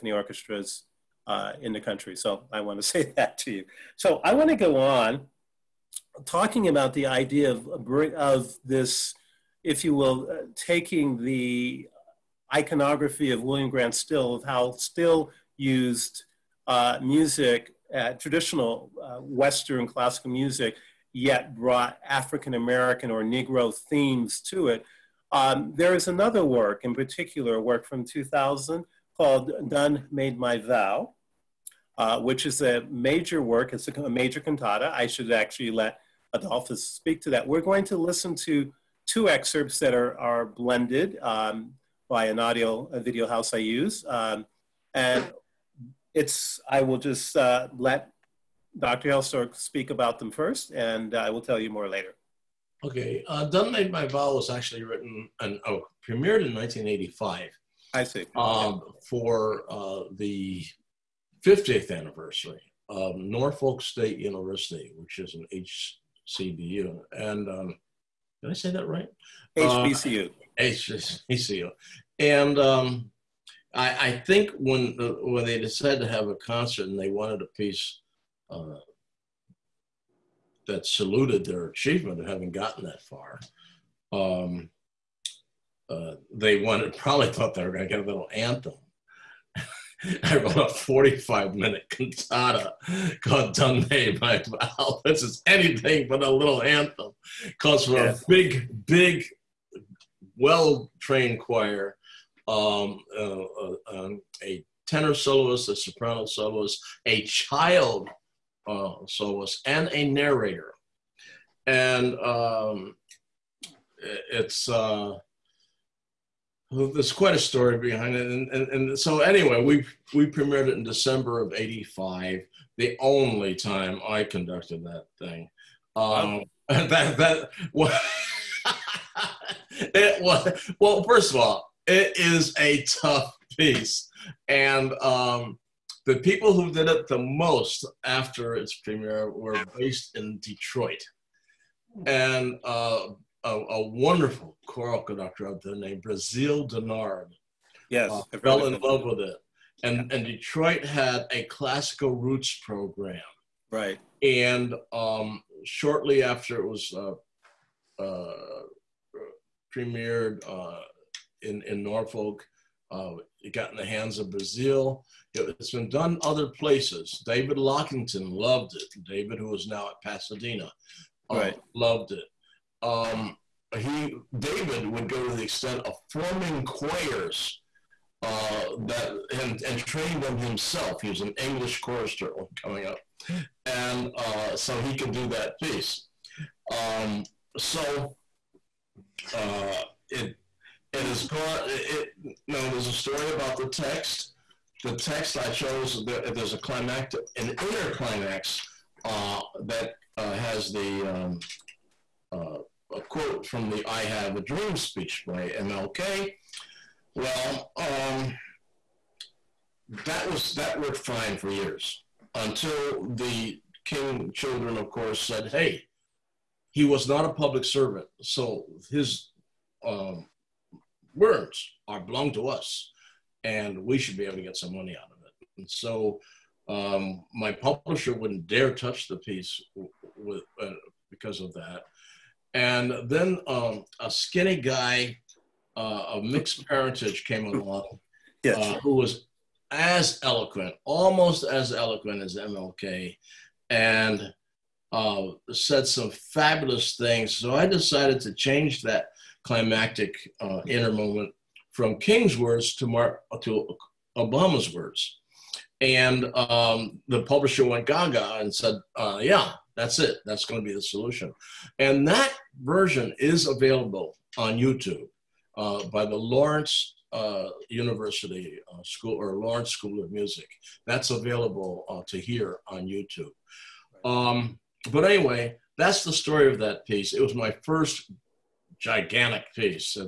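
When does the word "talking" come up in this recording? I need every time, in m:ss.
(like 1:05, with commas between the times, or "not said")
0:06.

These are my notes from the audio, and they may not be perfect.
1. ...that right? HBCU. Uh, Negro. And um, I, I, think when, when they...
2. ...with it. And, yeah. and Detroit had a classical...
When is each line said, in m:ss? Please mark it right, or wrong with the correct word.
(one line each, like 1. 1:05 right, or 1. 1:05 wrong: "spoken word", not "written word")
1. 1:08 wrong: "HBCU", not "Negro"
2. 2:29 right.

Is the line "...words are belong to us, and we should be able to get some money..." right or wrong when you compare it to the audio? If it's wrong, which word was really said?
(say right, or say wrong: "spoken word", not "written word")
right.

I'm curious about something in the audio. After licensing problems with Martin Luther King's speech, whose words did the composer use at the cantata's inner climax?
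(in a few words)
Obama.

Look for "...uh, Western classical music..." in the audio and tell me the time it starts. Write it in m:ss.
0:19.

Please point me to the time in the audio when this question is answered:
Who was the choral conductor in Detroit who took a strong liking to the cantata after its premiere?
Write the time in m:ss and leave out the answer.
2:26.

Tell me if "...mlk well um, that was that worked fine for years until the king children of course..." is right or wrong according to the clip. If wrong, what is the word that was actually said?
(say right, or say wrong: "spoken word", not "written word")
right.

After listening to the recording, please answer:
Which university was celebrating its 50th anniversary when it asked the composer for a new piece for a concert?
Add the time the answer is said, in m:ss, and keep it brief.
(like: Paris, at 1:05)
Norfolk State University, at 1:03.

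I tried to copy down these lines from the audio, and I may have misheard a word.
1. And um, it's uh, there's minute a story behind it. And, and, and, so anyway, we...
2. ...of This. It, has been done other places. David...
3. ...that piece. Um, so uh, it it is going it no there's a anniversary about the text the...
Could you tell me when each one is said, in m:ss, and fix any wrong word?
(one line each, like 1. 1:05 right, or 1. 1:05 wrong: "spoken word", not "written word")
1. 1:51 wrong: "quite", not "minute"
2. 2:44 wrong: "Brazeal", not "This"
3. 3:05 wrong: "story", not "anniversary".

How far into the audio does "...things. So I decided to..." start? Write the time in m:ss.
4:06.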